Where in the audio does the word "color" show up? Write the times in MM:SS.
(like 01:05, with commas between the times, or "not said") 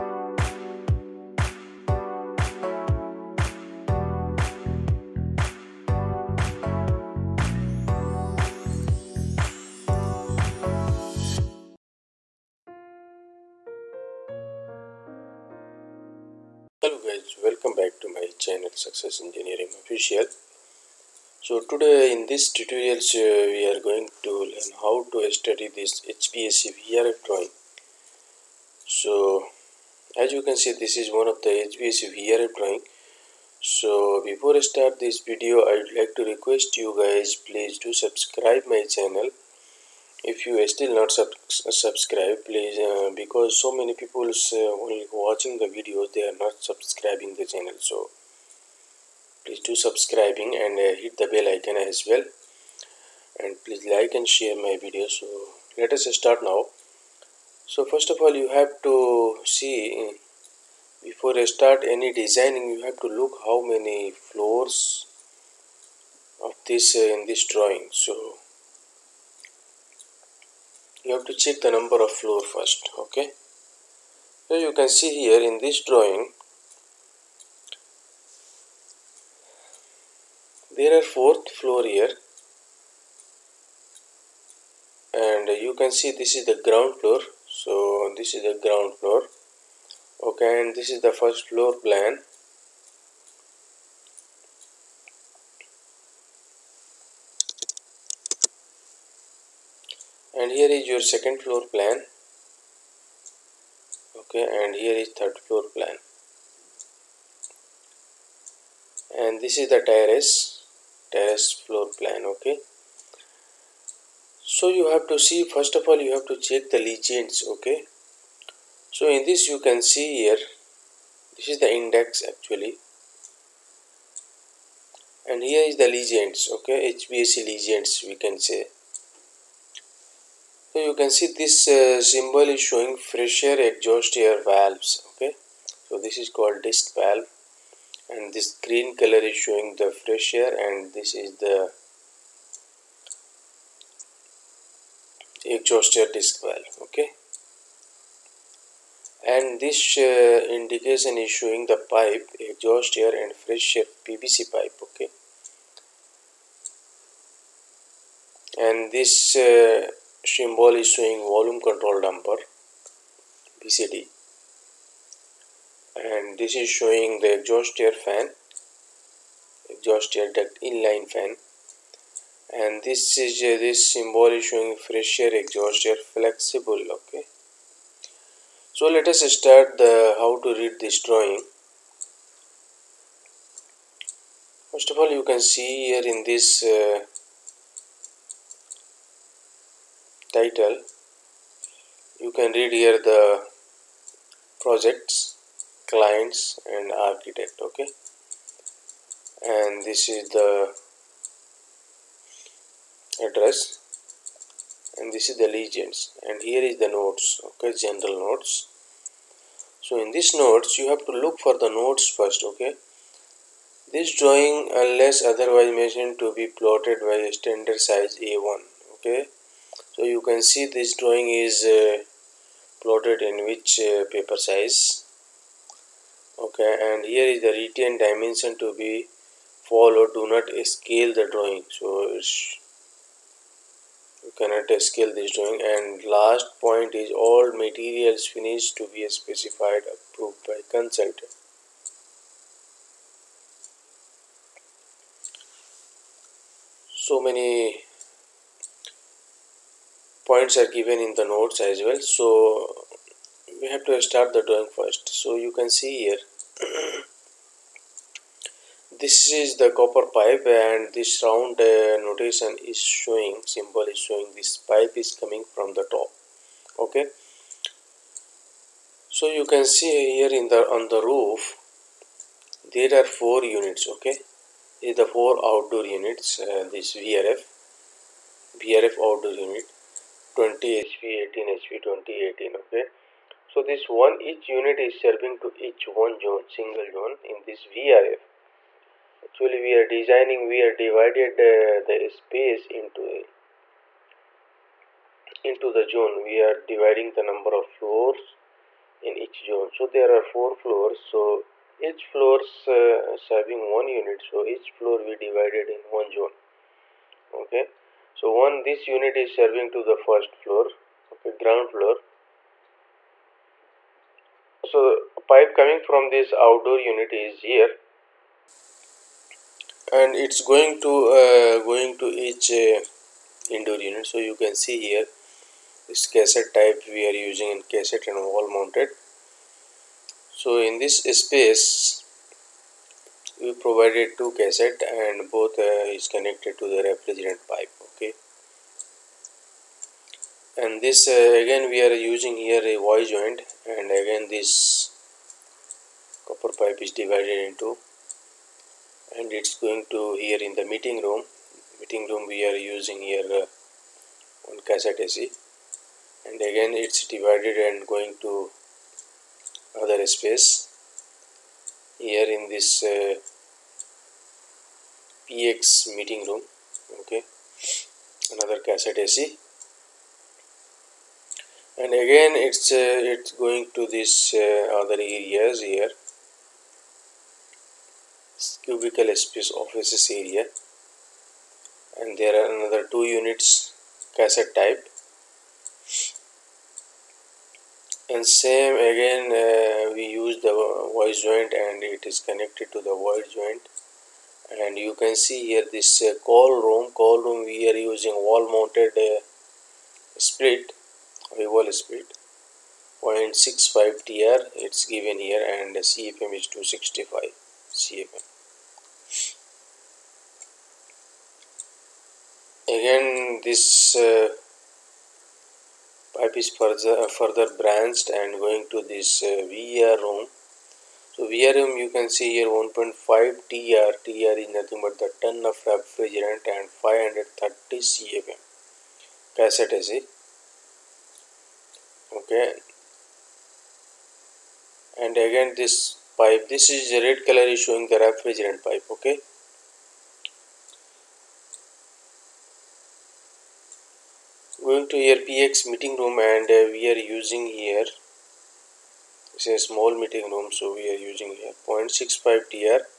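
02:18, 07:17.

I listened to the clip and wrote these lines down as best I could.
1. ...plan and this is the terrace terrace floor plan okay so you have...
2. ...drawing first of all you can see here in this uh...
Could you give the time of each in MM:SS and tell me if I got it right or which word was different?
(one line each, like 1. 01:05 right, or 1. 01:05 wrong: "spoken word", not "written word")
1. 01:45 right
2. 03:01 right.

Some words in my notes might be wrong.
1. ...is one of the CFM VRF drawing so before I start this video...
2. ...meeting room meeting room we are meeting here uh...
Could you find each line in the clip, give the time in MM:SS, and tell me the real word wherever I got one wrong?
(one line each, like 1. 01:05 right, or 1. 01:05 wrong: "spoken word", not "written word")
1. 00:30 wrong: "HVAC", not "CFM"
2. 05:50 wrong: "using", not "meeting".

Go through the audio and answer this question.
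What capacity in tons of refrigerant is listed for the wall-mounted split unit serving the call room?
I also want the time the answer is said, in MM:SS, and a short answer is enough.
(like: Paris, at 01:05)
0.65 TR, at 06:43.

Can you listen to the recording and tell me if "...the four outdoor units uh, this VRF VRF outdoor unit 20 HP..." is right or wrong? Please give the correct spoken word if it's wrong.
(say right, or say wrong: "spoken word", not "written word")
right.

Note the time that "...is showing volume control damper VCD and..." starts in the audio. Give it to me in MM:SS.
02:40.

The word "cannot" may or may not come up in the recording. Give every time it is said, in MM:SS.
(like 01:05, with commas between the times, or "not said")
03:54.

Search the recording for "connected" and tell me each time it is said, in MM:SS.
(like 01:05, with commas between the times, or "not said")
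05:36, 06:32.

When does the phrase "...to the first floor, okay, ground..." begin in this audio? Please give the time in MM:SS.
05:09.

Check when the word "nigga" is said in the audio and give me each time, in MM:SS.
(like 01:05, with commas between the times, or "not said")
not said.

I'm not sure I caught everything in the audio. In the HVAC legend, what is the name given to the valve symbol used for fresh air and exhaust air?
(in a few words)
Disc valve.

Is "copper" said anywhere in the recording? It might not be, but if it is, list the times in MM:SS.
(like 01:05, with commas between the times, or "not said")
04:19, 05:46.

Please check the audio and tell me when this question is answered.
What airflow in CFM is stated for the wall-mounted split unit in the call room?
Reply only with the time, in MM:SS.
06:46.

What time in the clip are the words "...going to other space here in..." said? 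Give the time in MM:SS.
05:57.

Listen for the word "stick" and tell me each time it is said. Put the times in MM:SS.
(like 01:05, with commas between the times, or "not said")
not said.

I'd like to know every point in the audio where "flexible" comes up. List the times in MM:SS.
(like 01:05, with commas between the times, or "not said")
02:56.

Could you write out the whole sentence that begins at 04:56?
We are dividing the number of floors in each zone.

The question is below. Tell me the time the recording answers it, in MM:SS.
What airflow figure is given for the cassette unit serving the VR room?
07:06.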